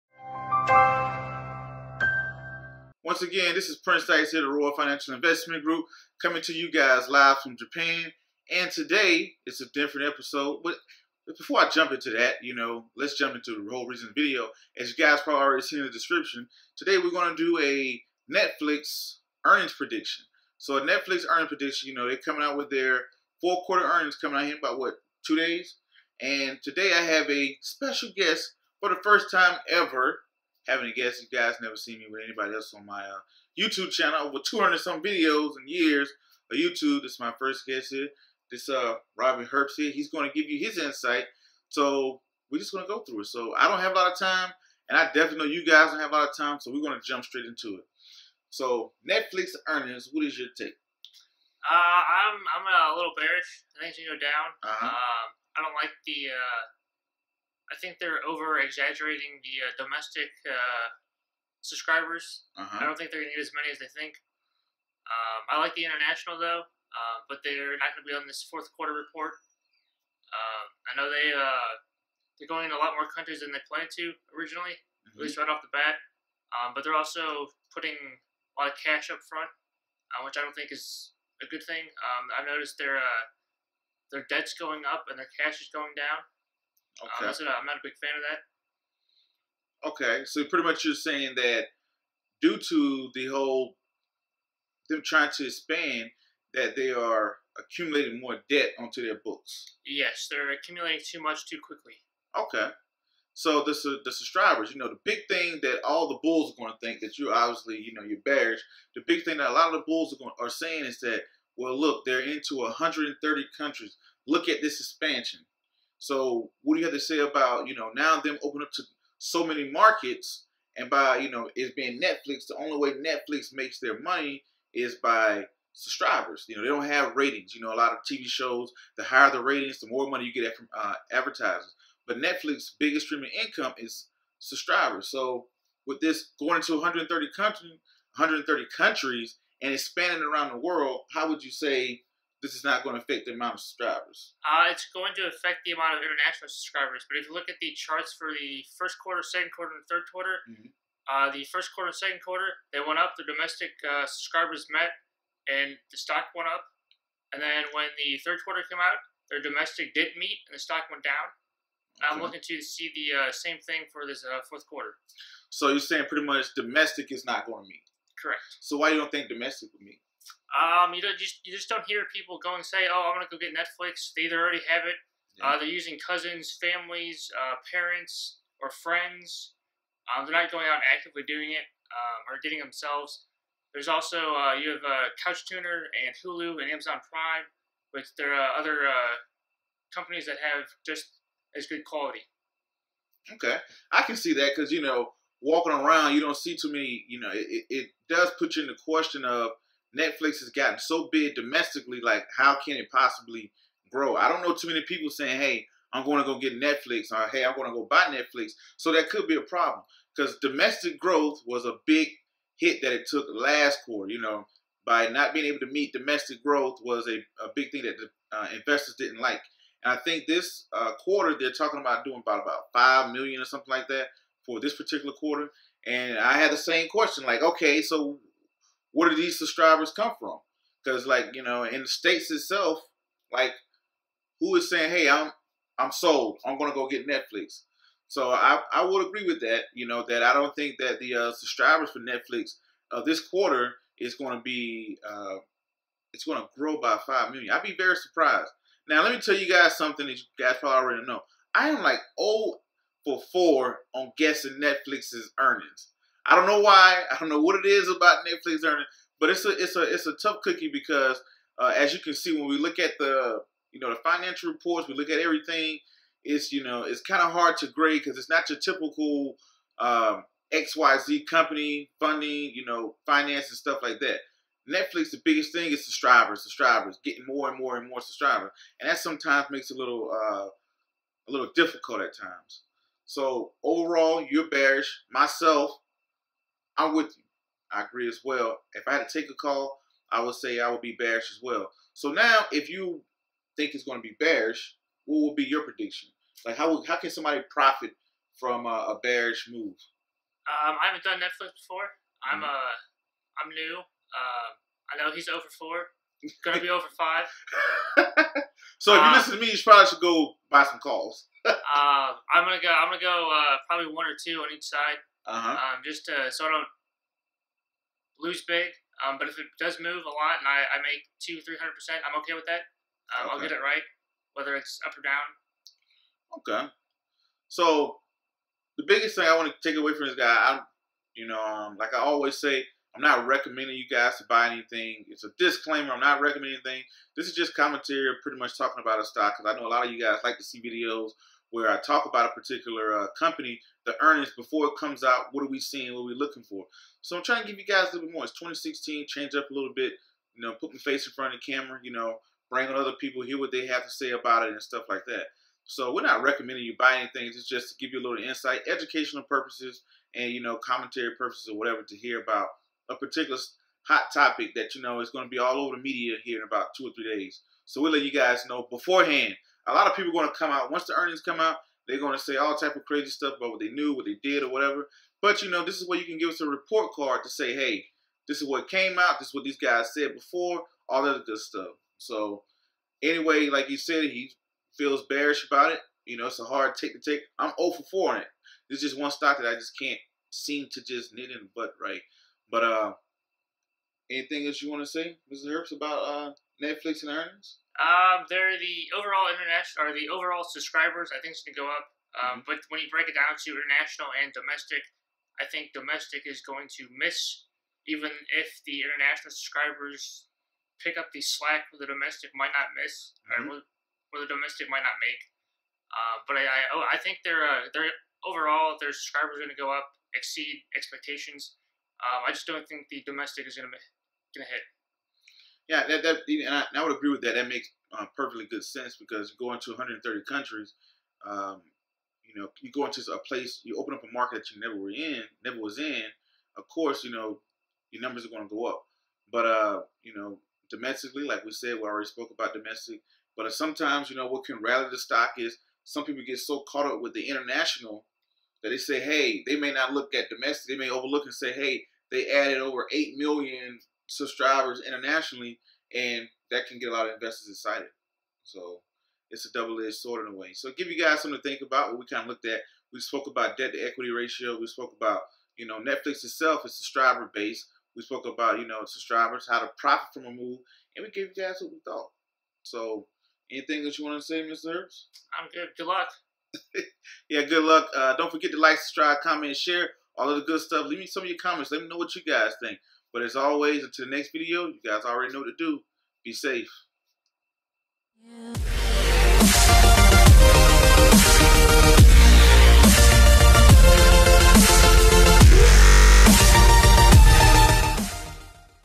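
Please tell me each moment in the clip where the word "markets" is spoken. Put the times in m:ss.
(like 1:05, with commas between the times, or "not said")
1:59, 7:14.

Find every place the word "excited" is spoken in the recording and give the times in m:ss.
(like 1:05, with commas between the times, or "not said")
7:37.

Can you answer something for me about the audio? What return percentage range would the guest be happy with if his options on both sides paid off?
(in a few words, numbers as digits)
200-300%.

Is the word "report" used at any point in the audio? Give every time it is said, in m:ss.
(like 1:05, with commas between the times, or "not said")
1:08, 4:24, 6:16.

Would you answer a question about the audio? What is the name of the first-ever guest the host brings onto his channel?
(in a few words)
Robin Herbst.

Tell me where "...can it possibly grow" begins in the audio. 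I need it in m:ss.
3:22.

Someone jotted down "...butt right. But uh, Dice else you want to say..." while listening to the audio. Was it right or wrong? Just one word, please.
wrong.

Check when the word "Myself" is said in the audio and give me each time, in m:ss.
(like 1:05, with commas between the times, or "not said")
4:45.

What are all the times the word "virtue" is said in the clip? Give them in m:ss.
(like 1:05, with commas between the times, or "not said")
not said.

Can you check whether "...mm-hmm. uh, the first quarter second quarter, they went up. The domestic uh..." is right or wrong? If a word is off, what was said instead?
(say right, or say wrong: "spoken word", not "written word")
right.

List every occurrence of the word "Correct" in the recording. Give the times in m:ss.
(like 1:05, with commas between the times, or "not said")
2:48.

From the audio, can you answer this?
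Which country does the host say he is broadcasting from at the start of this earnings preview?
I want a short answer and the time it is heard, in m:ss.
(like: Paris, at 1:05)
Japan, at 0:07.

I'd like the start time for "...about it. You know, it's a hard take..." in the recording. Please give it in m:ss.
6:25.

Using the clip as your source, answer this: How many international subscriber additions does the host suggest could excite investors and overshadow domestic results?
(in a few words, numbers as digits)
over 8 million.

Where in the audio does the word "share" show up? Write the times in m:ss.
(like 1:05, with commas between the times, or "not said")
7:59.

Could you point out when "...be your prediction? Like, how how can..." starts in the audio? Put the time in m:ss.
4:55.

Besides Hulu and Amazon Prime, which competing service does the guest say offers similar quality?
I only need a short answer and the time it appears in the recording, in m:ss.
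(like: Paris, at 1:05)
tuner, at 3:05.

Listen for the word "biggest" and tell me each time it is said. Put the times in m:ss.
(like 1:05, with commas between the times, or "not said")
2:12, 4:35, 5:28.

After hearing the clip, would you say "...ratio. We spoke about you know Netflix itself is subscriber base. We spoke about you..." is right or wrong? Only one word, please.
right.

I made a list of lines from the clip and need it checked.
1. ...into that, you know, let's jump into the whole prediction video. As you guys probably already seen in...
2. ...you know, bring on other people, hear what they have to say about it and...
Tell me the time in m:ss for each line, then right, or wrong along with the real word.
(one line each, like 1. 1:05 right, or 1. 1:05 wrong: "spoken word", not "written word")
1. 0:11 wrong: "reason", not "prediction"
2. 5:51 right.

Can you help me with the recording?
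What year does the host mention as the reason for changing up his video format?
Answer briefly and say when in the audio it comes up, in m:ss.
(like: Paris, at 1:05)
2016, at 5:48.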